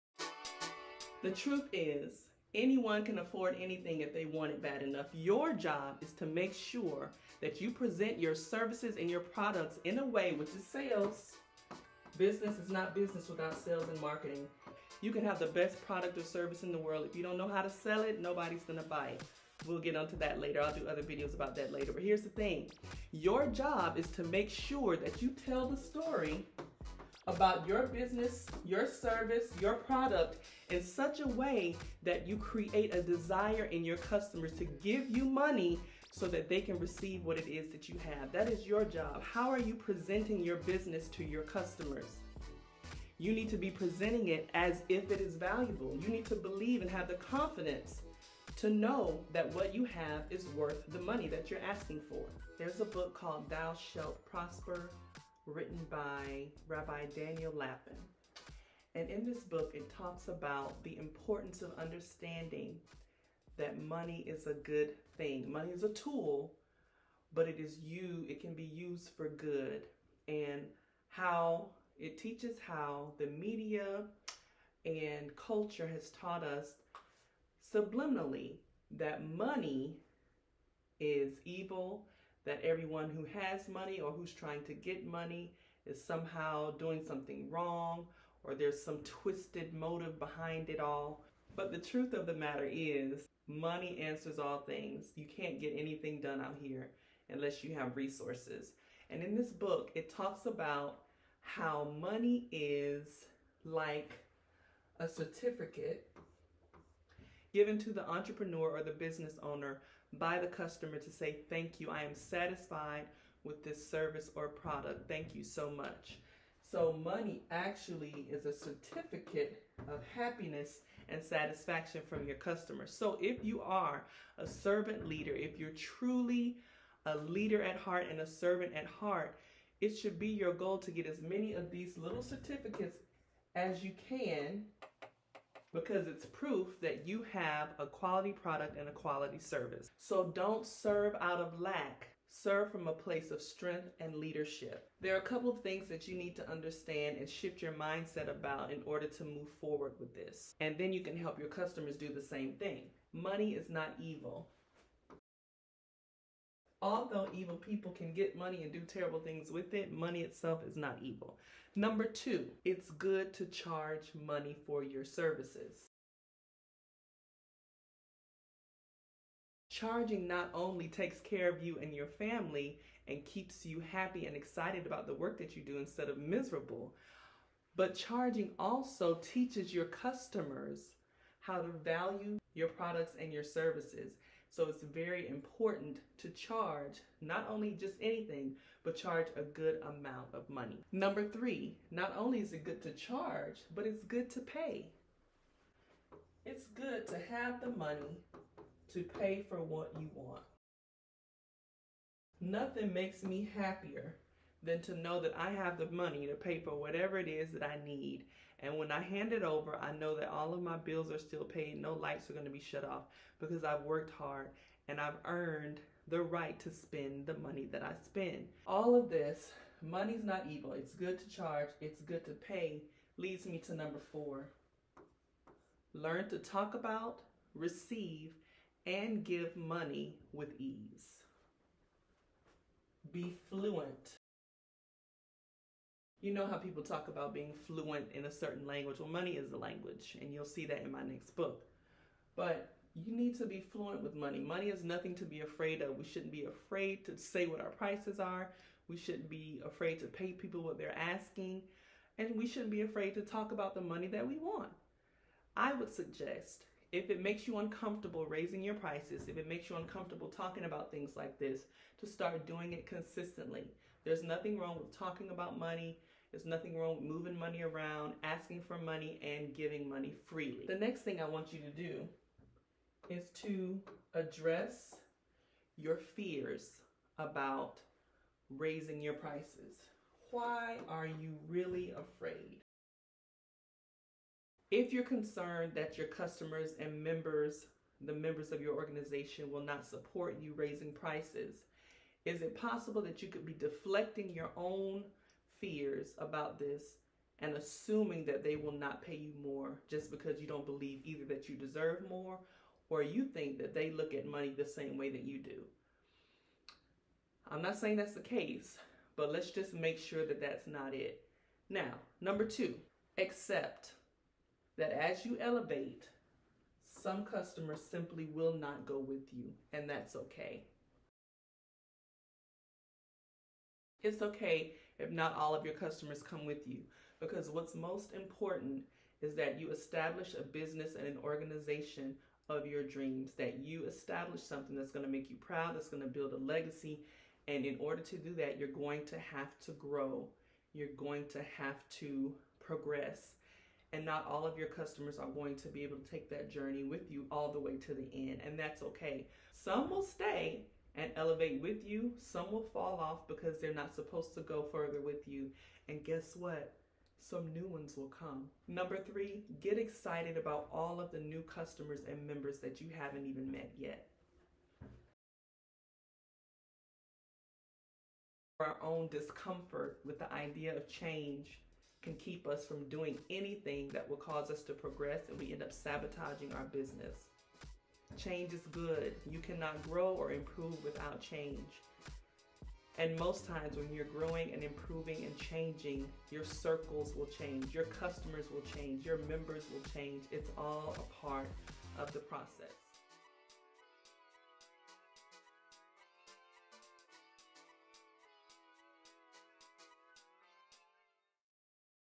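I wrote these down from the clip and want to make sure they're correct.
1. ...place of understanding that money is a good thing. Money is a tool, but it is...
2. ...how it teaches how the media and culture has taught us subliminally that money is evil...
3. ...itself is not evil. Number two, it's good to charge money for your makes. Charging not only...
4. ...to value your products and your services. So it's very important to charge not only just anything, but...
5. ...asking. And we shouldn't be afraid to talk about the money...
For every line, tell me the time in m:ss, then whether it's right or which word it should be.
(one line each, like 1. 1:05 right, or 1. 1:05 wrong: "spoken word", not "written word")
1. 1:00 wrong: "importance", not "place"
2. 1:11 right
3. 2:40 wrong: "services", not "makes"
4. 3:01 right
5. 4:10 right.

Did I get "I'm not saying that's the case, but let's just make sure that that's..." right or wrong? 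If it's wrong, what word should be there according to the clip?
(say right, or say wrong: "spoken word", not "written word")
right.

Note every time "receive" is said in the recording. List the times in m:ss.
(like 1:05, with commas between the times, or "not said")
0:36, 3:47.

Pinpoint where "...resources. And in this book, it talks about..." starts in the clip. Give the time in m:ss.
1:37.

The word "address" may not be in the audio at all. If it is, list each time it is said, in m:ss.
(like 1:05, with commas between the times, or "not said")
4:34.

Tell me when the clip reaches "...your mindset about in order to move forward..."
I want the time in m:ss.
2:27.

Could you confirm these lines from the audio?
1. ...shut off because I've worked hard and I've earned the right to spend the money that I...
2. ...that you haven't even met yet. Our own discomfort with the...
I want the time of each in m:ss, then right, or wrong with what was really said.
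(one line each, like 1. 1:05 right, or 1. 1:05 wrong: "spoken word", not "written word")
1. 3:32 right
2. 6:02 right.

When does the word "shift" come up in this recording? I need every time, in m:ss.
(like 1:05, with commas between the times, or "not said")
2:27.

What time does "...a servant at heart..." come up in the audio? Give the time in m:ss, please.
2:08.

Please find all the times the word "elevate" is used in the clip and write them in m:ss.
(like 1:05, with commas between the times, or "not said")
5:15, 5:51.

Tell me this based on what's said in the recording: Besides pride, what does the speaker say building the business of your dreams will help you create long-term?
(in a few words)
a legacy.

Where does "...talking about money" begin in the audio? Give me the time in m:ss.
4:24.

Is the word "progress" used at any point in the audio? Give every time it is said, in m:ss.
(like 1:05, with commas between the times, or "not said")
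5:42, 6:14.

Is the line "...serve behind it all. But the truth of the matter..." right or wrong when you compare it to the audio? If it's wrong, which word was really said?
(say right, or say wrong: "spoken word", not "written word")
wrong: "motive", not "serve".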